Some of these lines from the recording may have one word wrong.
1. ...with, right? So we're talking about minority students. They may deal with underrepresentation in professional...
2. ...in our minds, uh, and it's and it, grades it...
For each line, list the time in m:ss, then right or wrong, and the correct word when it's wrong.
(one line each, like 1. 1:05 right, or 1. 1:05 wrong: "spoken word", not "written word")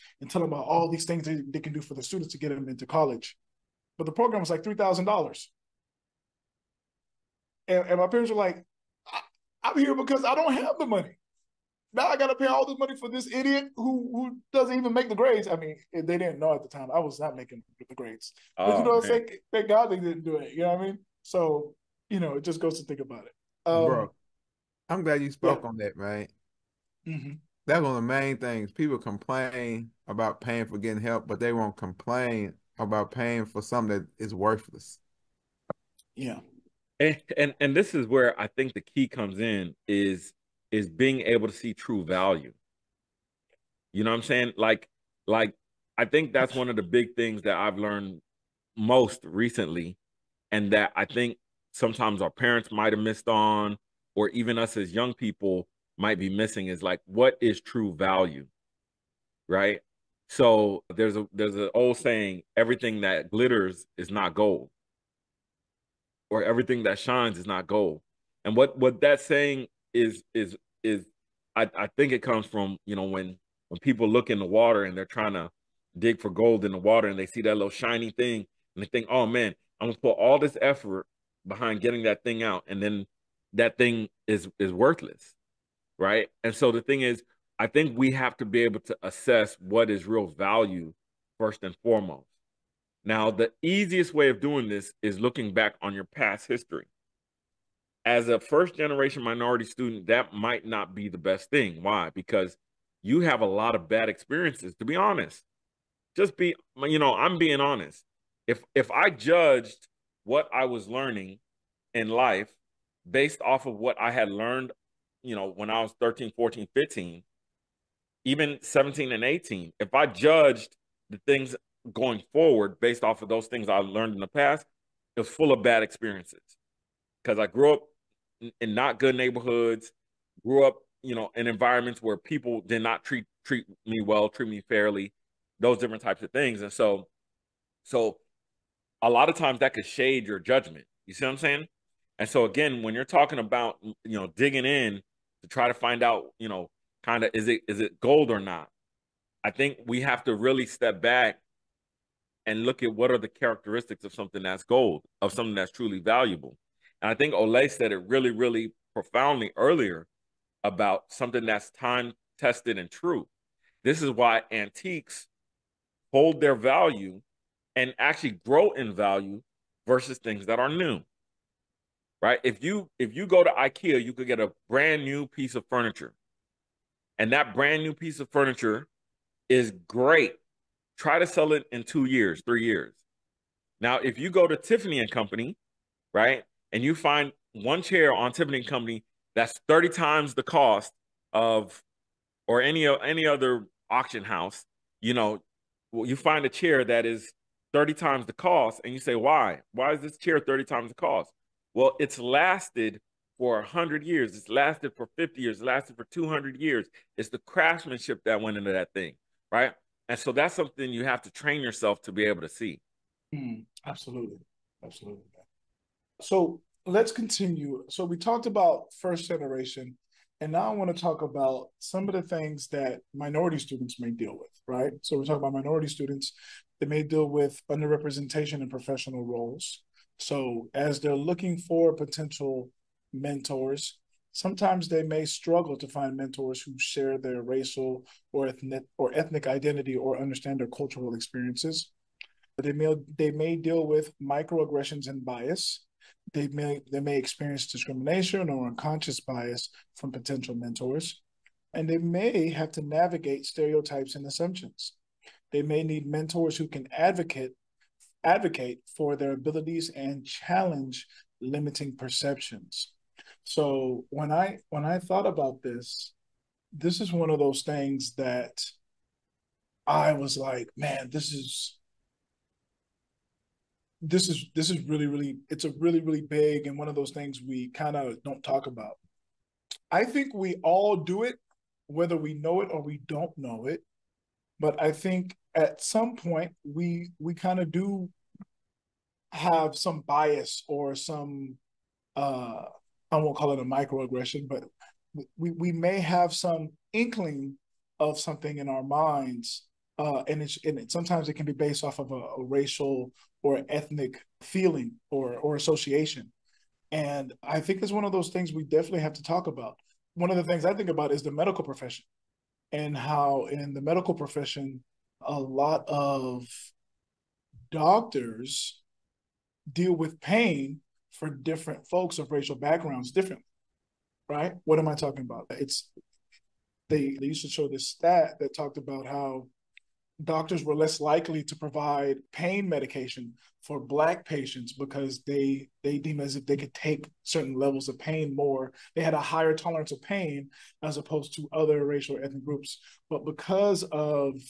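1. 3:44 right
2. 4:58 wrong: "sometimes", not "grades".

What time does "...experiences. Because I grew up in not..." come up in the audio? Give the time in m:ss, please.
2:05.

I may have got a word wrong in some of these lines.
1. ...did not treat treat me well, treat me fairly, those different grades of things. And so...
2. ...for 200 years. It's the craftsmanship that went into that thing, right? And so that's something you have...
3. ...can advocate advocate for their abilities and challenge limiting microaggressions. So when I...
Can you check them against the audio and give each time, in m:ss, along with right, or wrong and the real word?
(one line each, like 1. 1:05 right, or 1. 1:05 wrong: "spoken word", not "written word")
1. 2:12 wrong: "types", not "grades"
2. 3:25 right
3. 4:16 wrong: "perceptions", not "microaggressions".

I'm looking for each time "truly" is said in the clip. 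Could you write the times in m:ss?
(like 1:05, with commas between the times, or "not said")
2:35.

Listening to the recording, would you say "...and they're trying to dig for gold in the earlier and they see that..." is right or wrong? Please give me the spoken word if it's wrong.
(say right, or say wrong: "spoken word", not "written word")
wrong: "water", not "earlier".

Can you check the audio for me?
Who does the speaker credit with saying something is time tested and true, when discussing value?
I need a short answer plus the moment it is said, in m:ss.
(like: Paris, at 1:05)
Ole, at 2:37.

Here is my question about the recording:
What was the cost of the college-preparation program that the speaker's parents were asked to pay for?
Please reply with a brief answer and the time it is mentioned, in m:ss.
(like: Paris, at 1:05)
$3,000, at 0:04.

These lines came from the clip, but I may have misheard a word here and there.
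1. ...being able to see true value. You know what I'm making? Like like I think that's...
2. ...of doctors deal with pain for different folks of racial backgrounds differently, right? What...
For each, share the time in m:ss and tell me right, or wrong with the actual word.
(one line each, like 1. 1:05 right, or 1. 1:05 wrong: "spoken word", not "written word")
1. 0:40 wrong: "saying", not "making"
2. 5:15 right.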